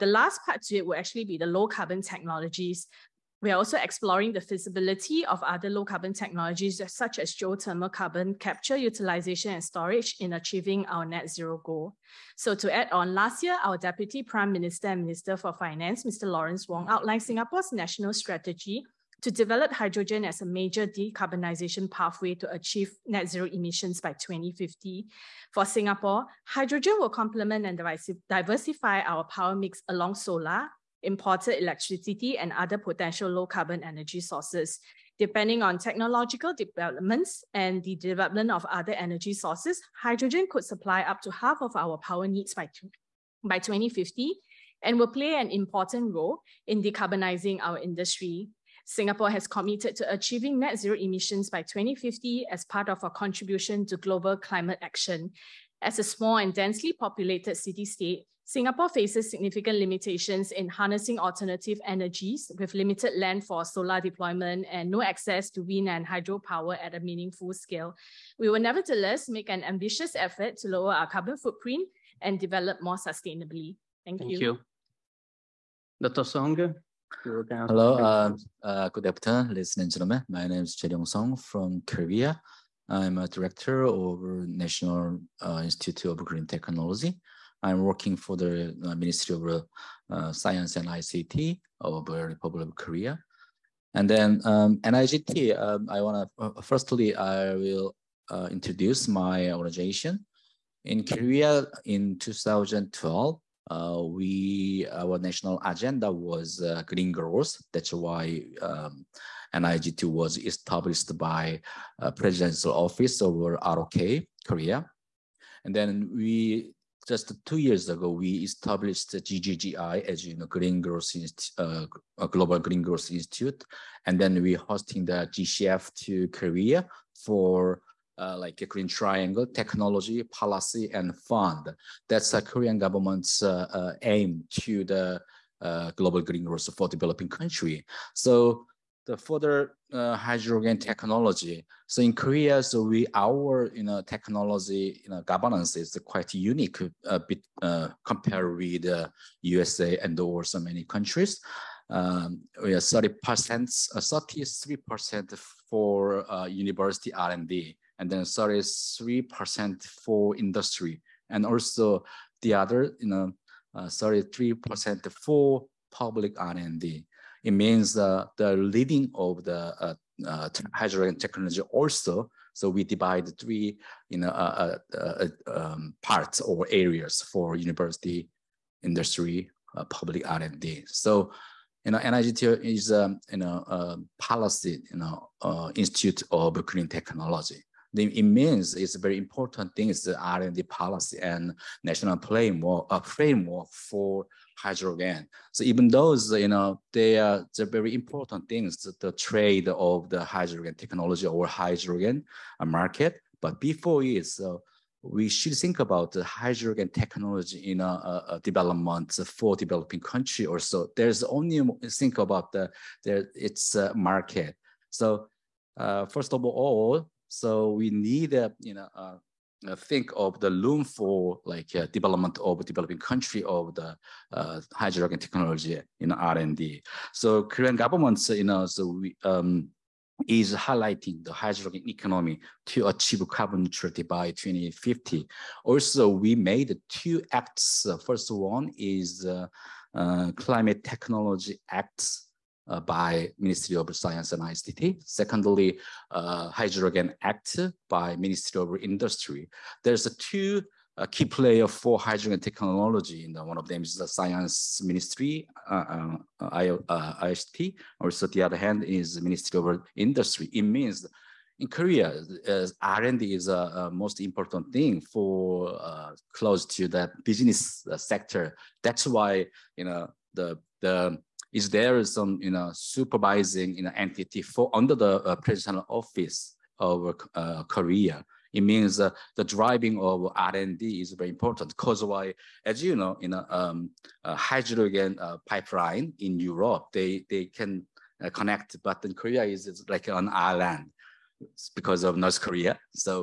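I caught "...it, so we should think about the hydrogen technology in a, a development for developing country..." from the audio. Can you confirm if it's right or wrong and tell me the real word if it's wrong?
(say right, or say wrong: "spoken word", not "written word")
right.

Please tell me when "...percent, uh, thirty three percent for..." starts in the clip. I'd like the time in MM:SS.
02:33.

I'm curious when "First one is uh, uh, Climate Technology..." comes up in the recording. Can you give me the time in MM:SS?
03:58.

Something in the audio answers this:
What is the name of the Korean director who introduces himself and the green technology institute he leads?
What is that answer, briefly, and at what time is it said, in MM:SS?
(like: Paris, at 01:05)
Jae Song, at 01:20.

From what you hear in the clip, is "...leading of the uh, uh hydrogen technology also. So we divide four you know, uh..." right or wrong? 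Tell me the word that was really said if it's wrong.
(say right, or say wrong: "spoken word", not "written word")
wrong: "three", not "four".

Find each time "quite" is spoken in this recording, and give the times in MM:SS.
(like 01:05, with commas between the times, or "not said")
02:26.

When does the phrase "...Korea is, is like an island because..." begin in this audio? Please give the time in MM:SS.
04:49.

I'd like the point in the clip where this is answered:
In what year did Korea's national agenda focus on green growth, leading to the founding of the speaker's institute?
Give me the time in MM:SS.
01:42.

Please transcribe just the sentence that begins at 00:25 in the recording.
For Singapore, hydrogen will complement and diversify our power mix along solar, imported electricity and other potential low carbon energy sources.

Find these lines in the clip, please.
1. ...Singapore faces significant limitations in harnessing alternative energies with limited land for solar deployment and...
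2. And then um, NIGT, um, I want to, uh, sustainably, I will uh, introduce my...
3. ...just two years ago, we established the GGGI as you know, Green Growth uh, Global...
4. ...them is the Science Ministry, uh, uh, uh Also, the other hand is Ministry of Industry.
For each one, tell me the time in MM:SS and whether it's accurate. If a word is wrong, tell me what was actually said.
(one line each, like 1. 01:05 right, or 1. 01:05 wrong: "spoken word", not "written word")
1. 00:58 right
2. 01:33 wrong: "firstly", not "sustainably"
3. 01:57 right
4. 04:13 right.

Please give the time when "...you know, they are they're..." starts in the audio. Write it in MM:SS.
03:16.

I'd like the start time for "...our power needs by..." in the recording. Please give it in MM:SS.
00:41.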